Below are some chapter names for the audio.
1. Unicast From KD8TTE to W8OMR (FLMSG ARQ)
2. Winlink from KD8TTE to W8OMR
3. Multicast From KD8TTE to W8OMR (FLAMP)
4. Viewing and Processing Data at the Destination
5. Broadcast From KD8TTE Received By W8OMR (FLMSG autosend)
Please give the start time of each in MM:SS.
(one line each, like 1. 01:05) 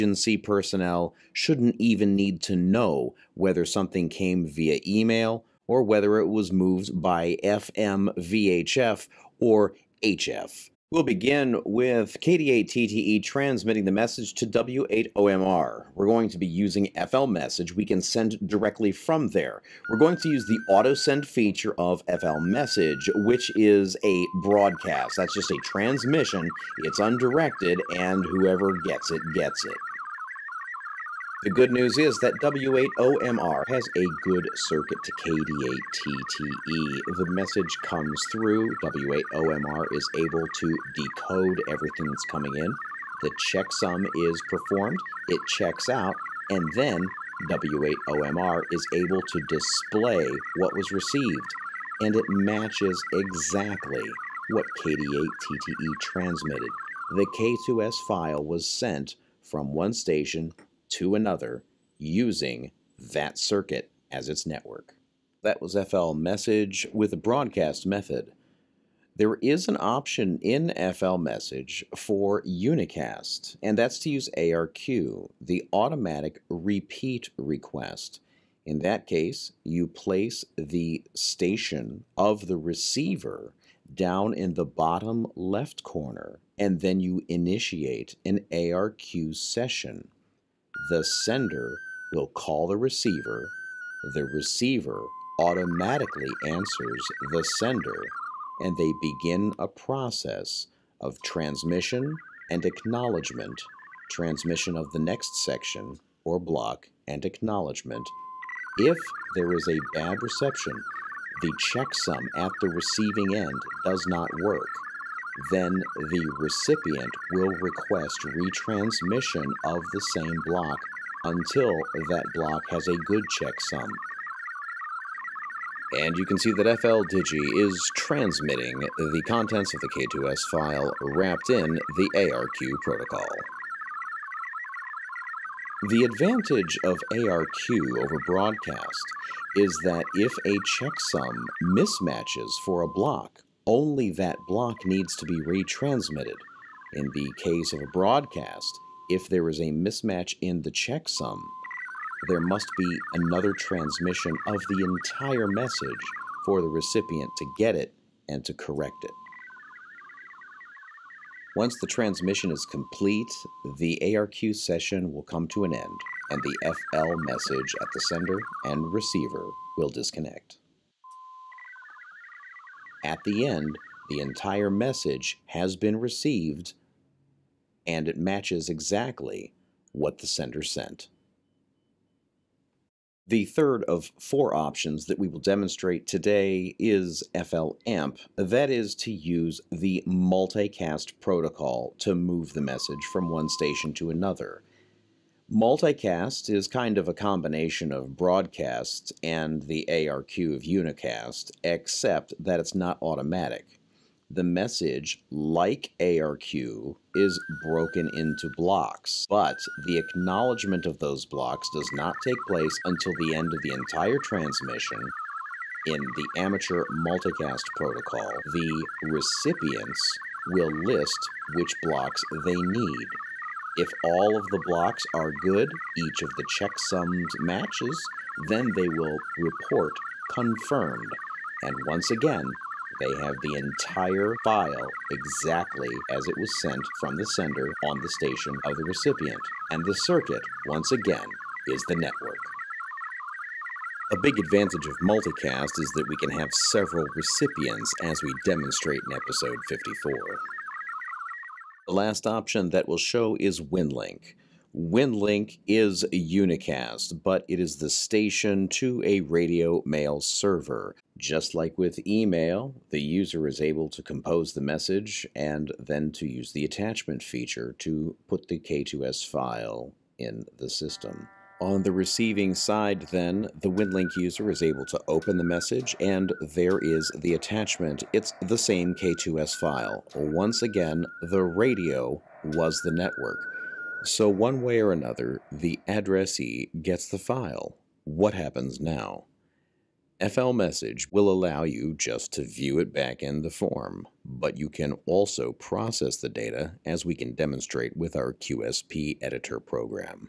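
1. 01:08
2. 04:13
3. 03:03
4. 04:44
5. 00:10.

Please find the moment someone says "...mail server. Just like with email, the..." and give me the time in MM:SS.
04:19.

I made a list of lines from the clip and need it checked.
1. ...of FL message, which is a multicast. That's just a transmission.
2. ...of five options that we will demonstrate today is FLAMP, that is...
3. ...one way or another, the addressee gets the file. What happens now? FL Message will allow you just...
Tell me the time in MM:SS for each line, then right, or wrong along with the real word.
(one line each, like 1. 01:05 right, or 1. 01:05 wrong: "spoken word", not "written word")
1. 00:21 wrong: "broadcast", not "multicast"
2. 03:03 wrong: "four", not "five"
3. 04:44 right.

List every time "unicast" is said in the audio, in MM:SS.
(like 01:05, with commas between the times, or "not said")
01:12, 03:20, 04:16.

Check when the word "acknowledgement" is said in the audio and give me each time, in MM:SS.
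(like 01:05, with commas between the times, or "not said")
01:42, 01:47, 03:29.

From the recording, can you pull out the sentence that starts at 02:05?
And you can see that FLDigi is transmitting the contents of the K2S file wrapped in the ARQ protocol.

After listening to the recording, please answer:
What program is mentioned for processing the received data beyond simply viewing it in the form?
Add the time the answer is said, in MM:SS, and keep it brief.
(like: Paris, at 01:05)
QSP editor, at 04:58.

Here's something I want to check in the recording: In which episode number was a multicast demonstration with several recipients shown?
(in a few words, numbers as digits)
54.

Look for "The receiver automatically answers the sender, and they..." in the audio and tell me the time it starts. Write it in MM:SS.
01:34.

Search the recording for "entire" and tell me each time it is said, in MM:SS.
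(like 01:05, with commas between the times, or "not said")
02:34, 02:54, 03:33, 03:53.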